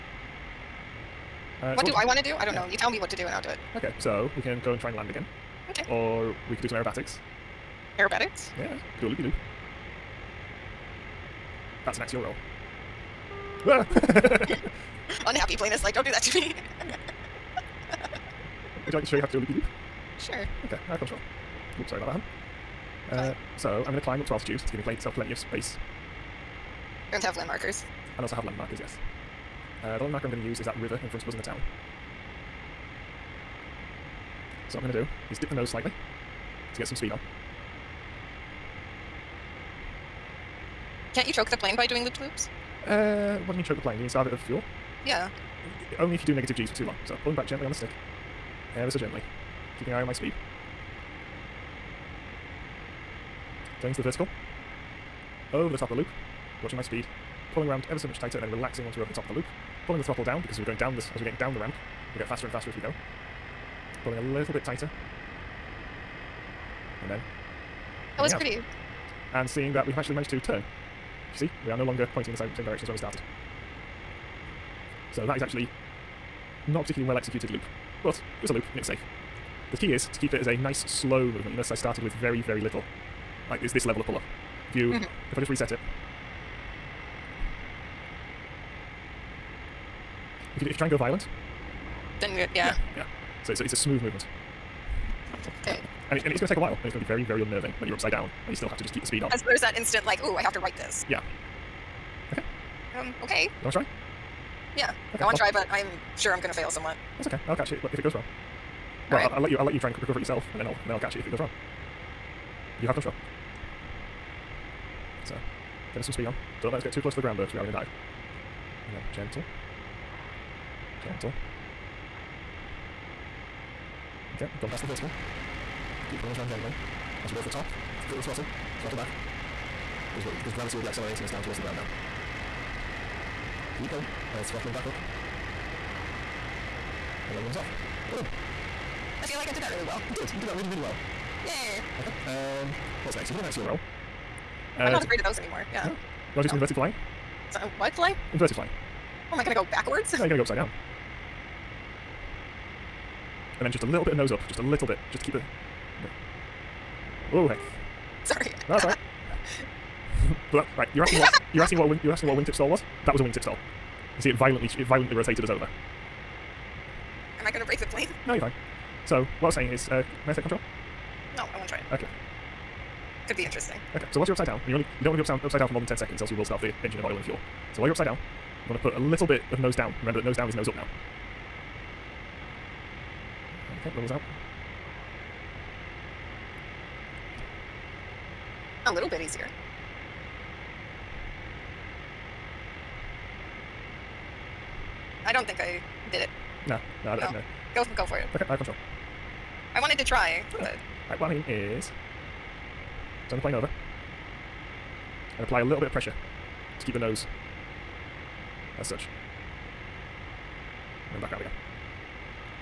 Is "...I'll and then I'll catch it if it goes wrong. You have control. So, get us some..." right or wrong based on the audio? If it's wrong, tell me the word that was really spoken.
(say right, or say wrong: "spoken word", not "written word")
right.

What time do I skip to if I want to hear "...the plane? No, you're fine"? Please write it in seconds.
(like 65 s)
167 s.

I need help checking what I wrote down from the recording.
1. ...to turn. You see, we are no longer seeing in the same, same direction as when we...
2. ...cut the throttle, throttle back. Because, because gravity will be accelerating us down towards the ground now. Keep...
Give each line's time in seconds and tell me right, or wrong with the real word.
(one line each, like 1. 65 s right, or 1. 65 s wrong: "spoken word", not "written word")
1. 70 s wrong: "pointing", not "seeing"
2. 128 s right.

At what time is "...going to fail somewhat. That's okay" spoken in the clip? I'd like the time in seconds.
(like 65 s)
106 s.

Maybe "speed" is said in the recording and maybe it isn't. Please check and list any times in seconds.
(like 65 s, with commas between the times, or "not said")
36 s, 50 s, 56 s, 99 s, 116 s.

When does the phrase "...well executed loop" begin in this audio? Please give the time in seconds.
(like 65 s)
77 s.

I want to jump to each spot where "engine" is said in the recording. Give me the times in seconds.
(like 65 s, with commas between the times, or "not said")
176 s.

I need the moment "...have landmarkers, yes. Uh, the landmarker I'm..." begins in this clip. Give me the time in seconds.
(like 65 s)
28 s.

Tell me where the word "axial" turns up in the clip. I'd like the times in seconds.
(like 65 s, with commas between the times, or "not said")
12 s, 143 s.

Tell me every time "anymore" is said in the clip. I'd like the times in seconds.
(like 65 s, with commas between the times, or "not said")
145 s.